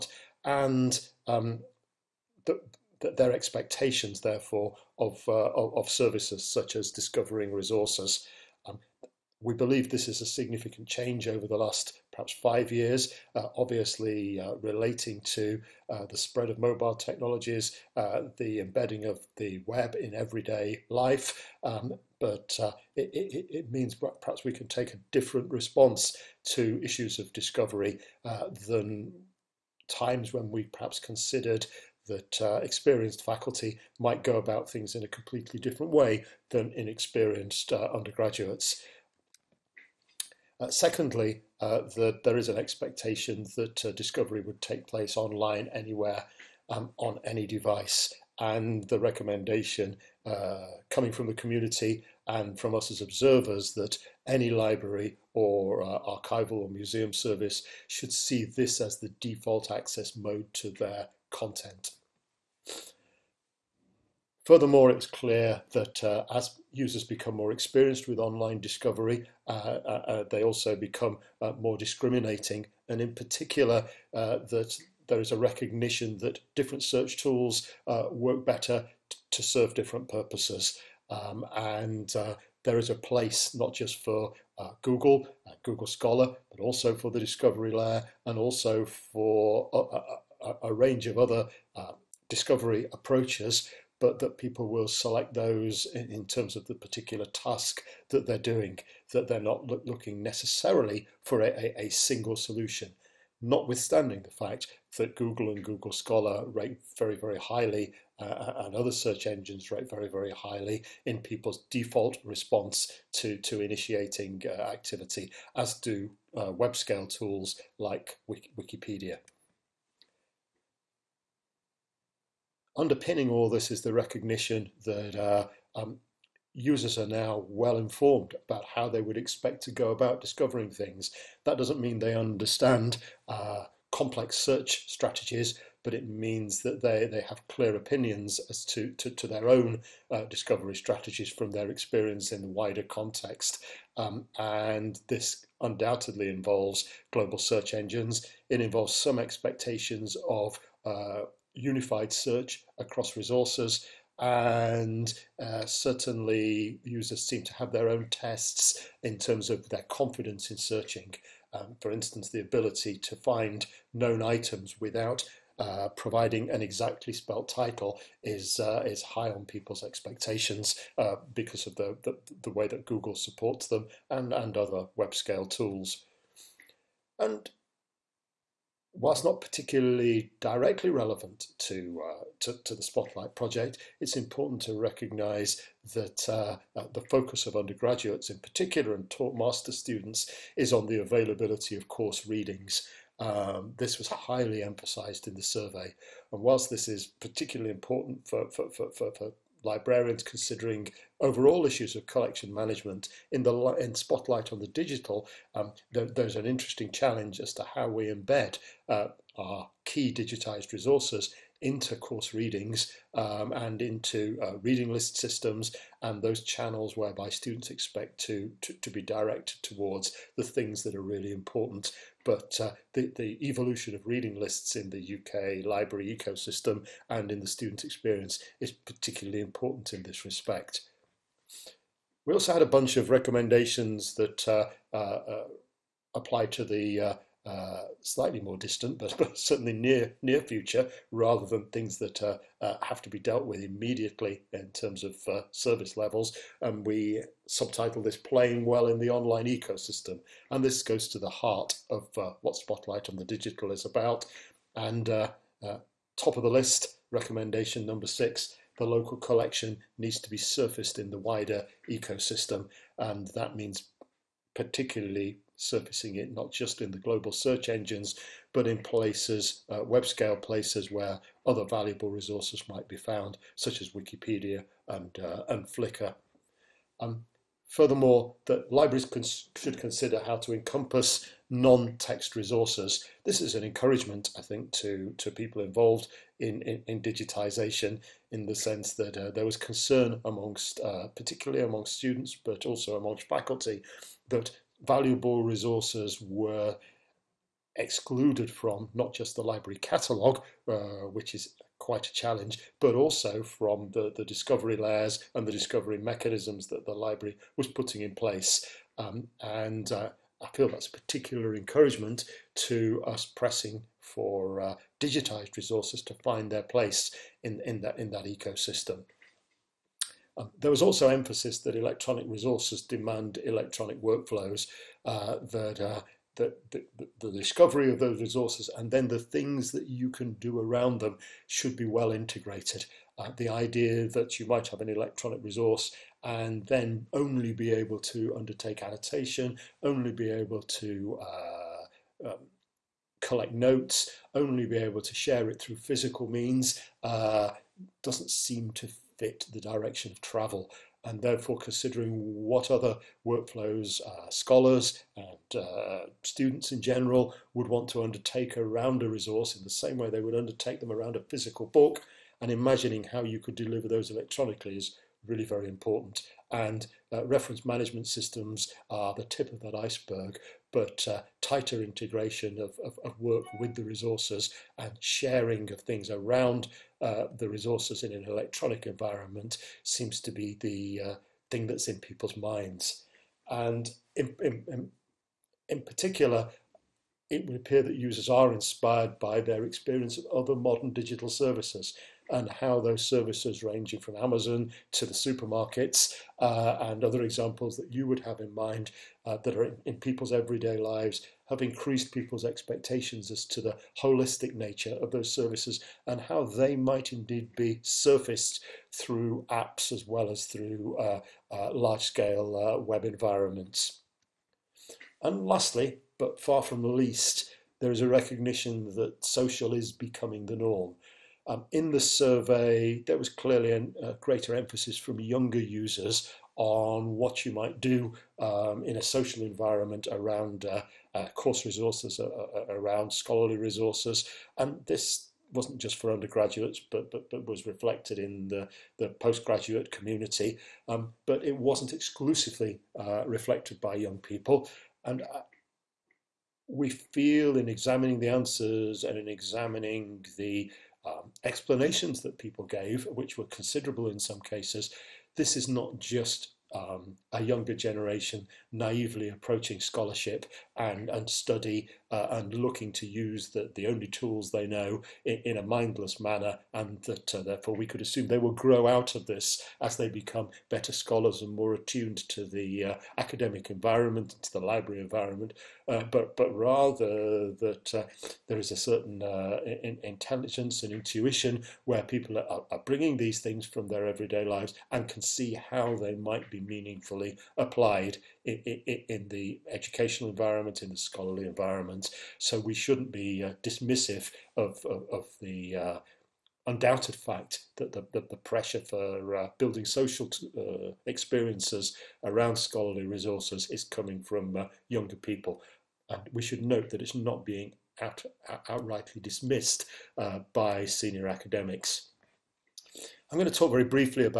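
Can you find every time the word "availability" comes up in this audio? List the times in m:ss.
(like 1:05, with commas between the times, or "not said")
3:10.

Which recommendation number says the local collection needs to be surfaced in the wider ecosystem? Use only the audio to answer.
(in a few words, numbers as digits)
6.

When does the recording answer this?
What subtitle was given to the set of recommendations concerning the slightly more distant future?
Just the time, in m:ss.
4:08.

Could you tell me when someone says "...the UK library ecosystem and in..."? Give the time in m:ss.
3:44.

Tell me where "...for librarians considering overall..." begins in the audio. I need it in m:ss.
3:19.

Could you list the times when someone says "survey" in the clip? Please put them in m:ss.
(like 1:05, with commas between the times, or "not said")
3:15, 7:01.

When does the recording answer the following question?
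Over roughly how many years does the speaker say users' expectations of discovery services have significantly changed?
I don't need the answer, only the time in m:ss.
0:12.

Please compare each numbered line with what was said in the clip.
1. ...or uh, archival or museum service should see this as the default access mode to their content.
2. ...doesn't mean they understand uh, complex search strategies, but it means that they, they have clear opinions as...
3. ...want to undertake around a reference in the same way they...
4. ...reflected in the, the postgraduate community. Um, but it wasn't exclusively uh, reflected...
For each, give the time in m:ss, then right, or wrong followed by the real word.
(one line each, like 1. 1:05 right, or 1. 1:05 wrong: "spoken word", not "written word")
1. 0:55 right
2. 2:11 right
3. 5:57 wrong: "resource", not "reference"
4. 7:17 right.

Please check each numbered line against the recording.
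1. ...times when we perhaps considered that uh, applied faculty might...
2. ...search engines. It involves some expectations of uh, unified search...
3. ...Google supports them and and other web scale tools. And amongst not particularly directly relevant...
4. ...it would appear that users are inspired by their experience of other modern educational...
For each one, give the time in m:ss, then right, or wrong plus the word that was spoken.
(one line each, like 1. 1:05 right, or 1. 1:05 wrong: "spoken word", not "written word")
1. 0:29 wrong: "experienced", not "applied"
2. 2:27 right
3. 2:52 wrong: "whilst", not "amongst"
4. 6:27 wrong: "digital", not "educational".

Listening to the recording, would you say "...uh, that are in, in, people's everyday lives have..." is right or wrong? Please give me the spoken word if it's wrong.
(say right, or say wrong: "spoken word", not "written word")
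right.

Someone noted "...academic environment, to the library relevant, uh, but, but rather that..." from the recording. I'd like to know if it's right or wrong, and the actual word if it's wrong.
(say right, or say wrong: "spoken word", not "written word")
wrong: "environment", not "relevant".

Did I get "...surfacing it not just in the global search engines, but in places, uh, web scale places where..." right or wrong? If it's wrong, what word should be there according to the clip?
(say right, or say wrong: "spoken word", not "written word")
right.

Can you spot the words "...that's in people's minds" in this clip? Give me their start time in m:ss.
6:21.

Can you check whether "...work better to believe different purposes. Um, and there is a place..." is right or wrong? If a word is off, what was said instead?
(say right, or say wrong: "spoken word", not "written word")
wrong: "serve", not "believe".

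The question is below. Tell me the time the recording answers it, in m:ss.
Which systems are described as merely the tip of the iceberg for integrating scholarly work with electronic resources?
6:07.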